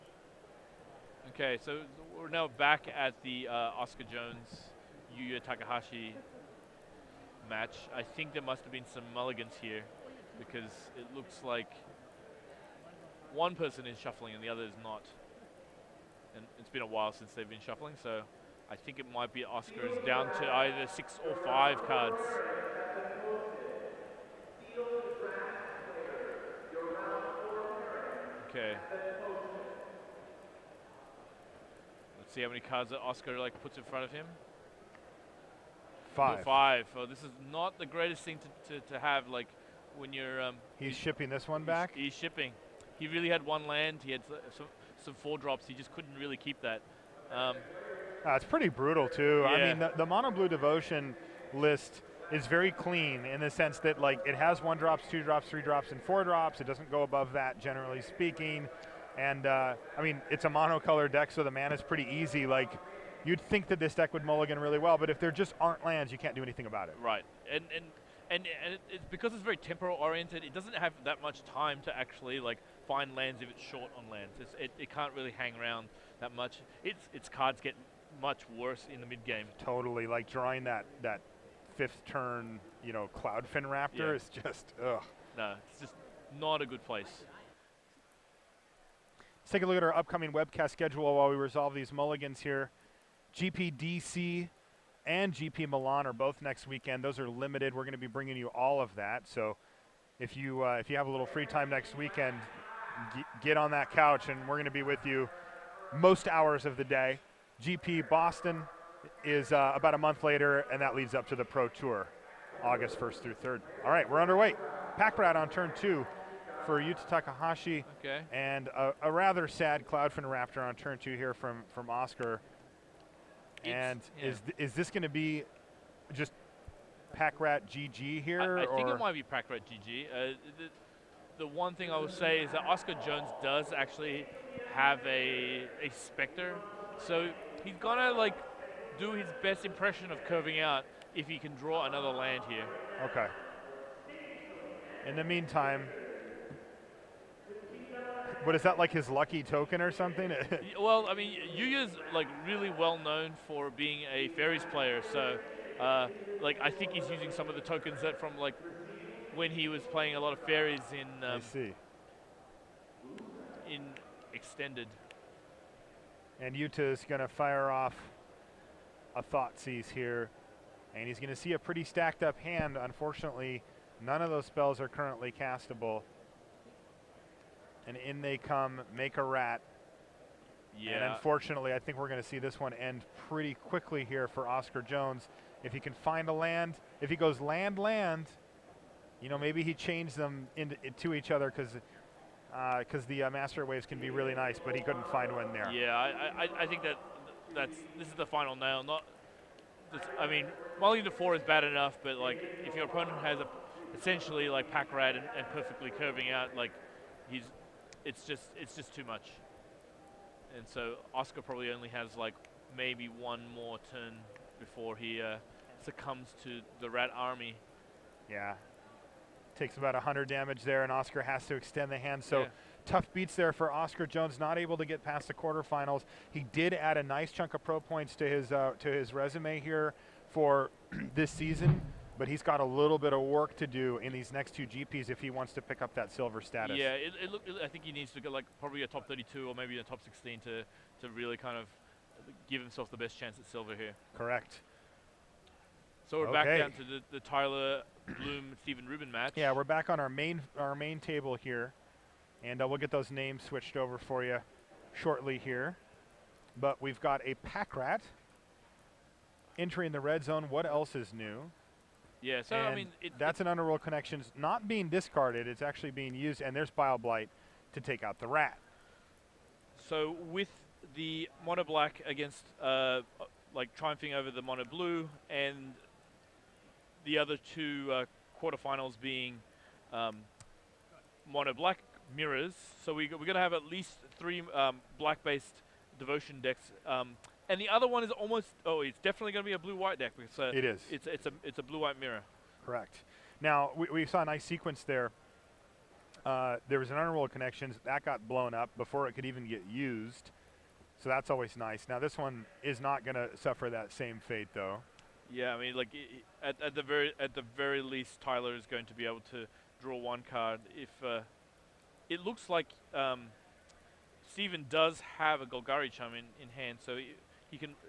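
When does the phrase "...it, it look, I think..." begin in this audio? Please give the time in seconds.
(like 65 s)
236 s.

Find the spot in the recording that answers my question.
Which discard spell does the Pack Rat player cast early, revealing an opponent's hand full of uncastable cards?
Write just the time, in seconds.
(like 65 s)
169 s.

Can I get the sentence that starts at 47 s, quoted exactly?
Um, uh, it's pretty brutal too.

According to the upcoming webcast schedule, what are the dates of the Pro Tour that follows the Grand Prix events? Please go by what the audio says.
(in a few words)
August 1st through 3rd.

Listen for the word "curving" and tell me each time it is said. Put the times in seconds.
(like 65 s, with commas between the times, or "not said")
140 s, 205 s.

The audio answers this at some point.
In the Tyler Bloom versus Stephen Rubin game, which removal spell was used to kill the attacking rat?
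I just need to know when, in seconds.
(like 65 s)
266 s.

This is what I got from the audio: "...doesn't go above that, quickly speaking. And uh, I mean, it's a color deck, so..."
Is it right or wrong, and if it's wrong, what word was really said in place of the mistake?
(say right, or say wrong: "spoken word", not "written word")
wrong: "generally", not "quickly".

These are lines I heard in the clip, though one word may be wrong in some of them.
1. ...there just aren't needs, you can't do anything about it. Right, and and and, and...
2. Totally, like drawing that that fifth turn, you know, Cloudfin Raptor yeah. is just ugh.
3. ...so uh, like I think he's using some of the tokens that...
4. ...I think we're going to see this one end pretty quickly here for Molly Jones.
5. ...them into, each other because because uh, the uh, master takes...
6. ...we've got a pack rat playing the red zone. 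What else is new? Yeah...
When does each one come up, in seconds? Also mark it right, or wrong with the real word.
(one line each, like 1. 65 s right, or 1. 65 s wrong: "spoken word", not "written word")
1. 65 s wrong: "lands", not "needs"
2. 79 s right
3. 155 s right
4. 181 s wrong: "Oscar", not "Molly"
5. 190 s wrong: "waves", not "takes"
6. 256 s wrong: "entering", not "playing".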